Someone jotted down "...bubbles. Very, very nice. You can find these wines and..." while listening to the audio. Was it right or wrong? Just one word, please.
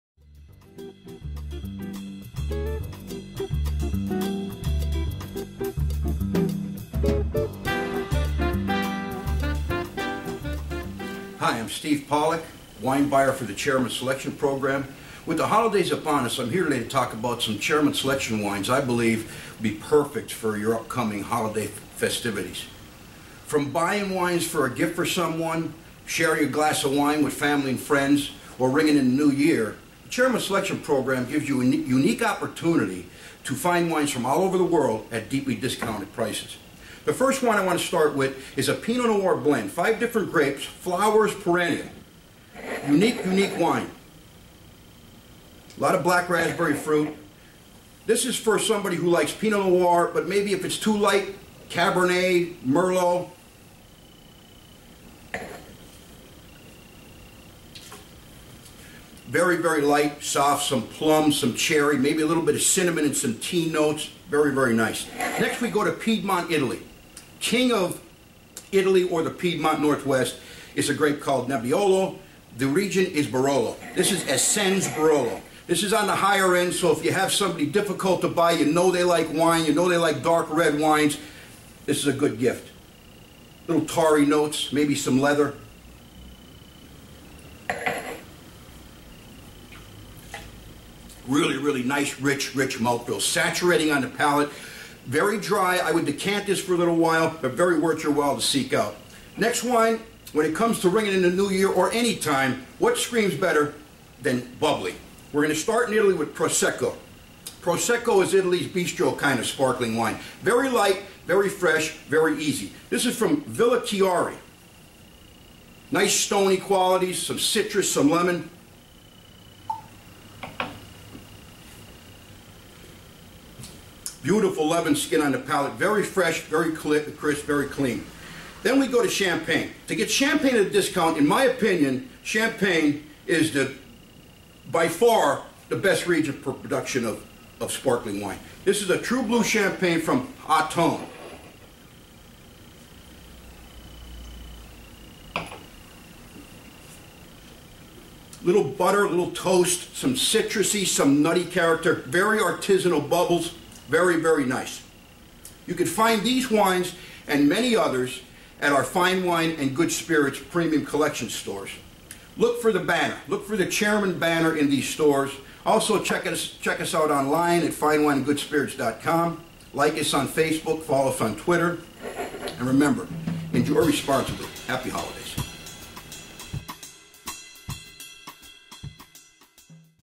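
right.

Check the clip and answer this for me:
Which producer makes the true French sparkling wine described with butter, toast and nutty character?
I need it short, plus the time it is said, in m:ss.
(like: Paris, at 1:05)
Aton, at 2:20.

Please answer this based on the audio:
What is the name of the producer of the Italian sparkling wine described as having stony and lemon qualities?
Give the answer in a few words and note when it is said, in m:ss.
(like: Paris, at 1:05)
Villa Chiari, at 1:53.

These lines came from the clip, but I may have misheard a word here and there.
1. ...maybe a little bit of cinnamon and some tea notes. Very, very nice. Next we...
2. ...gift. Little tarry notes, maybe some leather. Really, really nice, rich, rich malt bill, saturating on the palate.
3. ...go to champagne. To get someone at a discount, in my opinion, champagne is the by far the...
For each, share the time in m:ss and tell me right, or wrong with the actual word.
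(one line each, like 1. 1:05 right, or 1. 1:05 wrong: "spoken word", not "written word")
1. 1:01 right
2. 1:22 right
3. 2:08 wrong: "champagne", not "someone".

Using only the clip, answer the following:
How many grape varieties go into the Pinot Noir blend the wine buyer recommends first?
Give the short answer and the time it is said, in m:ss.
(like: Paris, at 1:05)
5, at 0:39.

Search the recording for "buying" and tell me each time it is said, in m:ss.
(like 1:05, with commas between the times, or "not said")
0:23.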